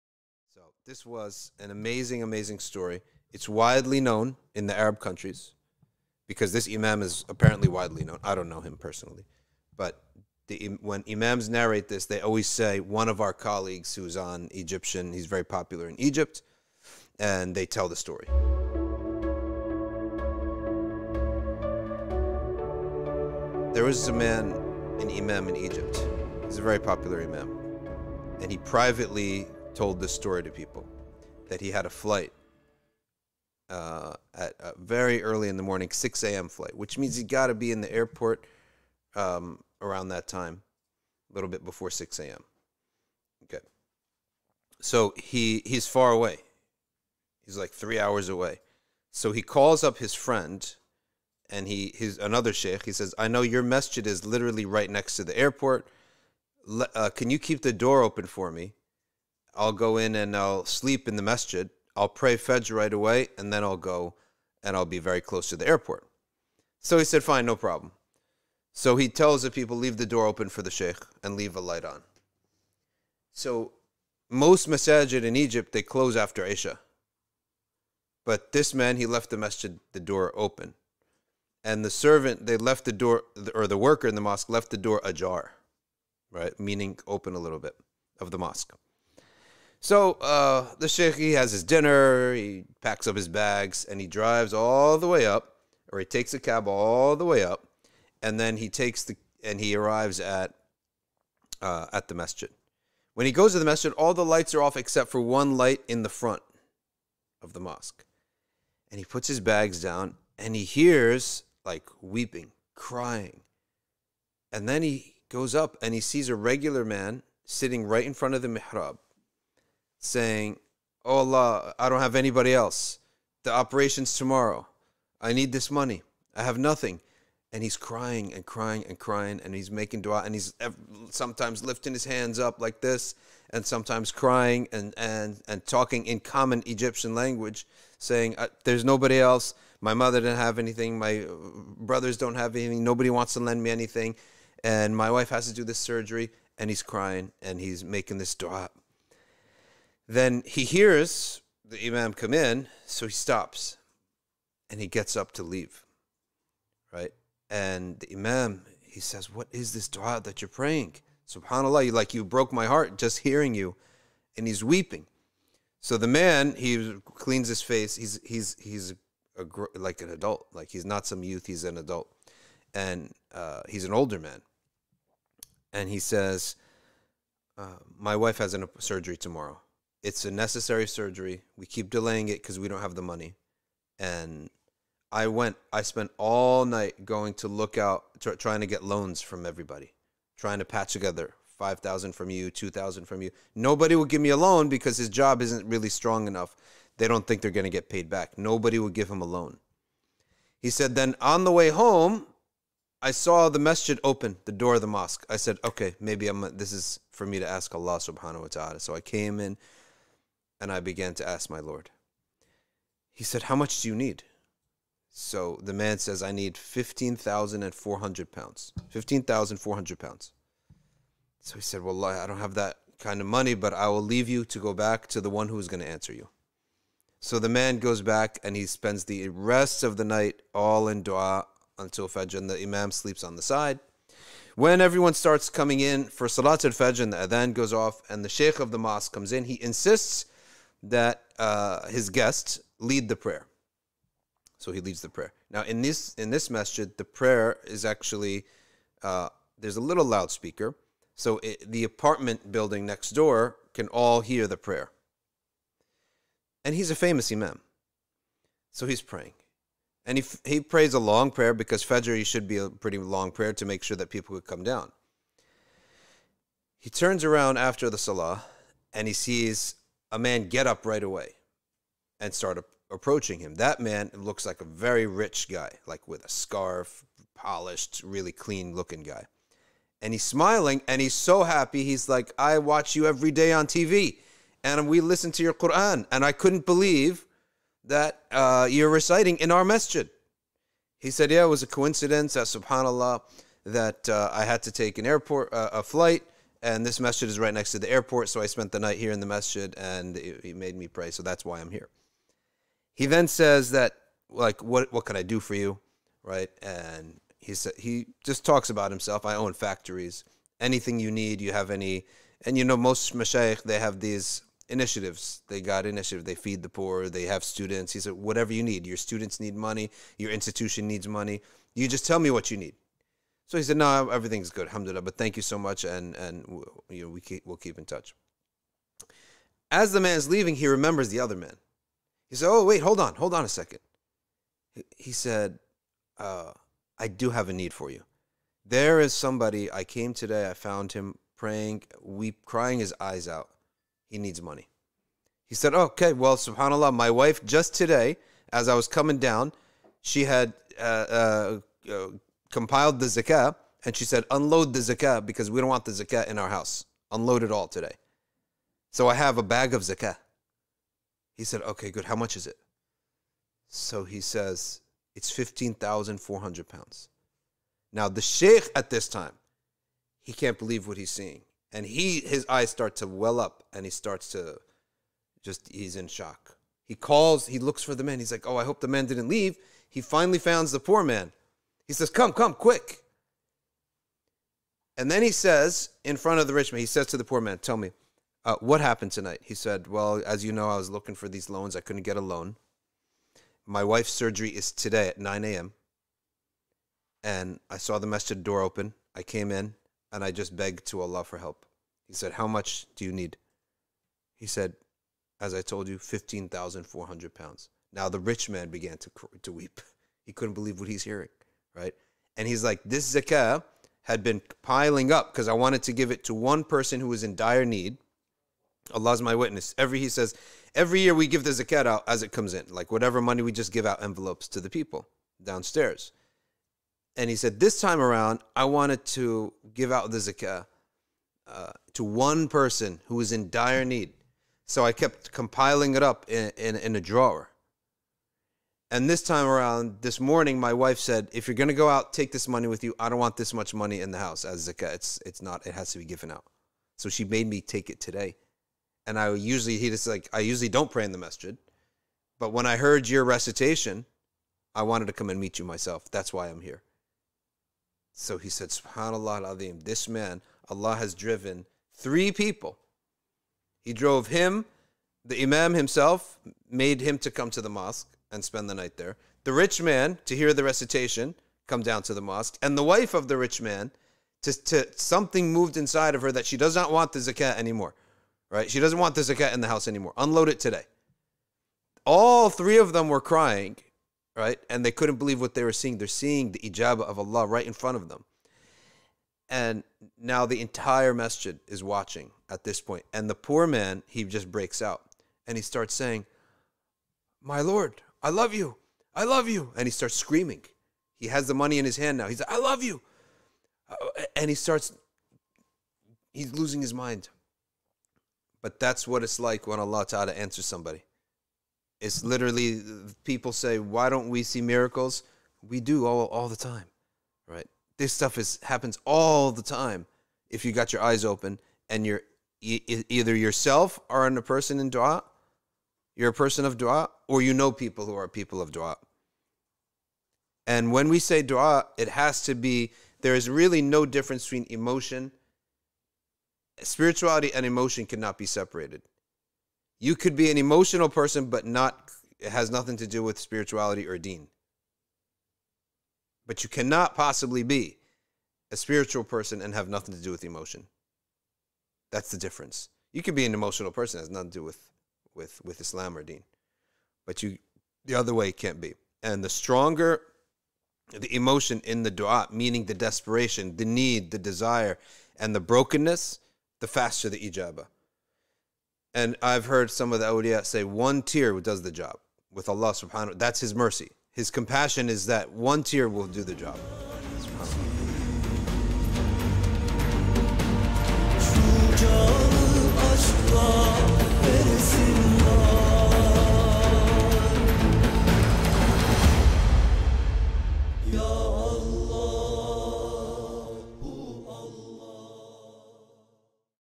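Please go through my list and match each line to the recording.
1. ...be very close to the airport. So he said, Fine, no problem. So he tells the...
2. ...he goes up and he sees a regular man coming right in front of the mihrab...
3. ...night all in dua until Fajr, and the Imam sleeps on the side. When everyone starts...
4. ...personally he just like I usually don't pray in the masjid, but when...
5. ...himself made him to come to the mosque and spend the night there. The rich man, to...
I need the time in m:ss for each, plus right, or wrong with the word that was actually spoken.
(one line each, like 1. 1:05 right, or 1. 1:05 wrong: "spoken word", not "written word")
1. 1:04 right
2. 1:54 wrong: "sitting", not "coming"
3. 3:50 right
4. 7:29 wrong: "usually", not "personally"
5. 7:45 right.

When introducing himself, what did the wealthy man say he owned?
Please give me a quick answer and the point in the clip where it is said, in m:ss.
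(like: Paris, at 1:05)
factories, at 5:09.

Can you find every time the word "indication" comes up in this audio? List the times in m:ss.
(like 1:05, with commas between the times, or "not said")
not said.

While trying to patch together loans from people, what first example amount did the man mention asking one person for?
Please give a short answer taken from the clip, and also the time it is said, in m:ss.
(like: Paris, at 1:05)
5,000, at 3:11.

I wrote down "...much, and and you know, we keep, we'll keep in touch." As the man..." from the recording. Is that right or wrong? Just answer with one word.
right.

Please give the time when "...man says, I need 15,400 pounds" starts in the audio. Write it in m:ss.
3:35.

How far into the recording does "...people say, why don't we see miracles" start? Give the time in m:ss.
8:33.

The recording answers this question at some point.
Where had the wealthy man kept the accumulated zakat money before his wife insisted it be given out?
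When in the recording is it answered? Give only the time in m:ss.
7:16.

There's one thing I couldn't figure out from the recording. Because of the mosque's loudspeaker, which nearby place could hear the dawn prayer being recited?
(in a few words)
the apartment building next door.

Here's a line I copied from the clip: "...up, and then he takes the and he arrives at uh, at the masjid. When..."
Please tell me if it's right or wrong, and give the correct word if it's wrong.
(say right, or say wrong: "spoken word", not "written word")
right.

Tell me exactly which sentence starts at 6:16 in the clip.
He calls, he looks for the man.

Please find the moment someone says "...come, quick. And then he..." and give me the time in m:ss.
6:22.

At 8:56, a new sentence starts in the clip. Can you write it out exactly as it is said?
Spirituality and emotion cannot be separated.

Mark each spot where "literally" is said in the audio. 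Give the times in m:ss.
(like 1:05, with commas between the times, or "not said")
0:54, 8:32.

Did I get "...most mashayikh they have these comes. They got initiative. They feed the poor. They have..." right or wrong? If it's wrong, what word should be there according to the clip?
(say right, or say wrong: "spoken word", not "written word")
wrong: "initiatives", not "comes".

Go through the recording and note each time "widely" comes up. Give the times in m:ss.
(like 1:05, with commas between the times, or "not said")
0:03, 0:07.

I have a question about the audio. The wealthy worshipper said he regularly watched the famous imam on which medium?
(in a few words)
TV.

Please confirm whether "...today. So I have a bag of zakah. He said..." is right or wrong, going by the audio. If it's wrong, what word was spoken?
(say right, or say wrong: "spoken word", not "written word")
right.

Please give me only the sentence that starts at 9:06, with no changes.
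But you cannot possibly be a spiritual person and have nothing to do with emotion.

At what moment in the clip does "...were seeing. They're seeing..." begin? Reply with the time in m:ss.
8:05.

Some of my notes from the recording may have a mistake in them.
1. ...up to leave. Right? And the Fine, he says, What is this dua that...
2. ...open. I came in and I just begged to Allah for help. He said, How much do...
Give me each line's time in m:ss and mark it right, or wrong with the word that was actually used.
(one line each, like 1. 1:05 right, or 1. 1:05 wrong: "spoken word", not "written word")
1. 2:35 wrong: "Imam", not "Fine"
2. 6:38 right.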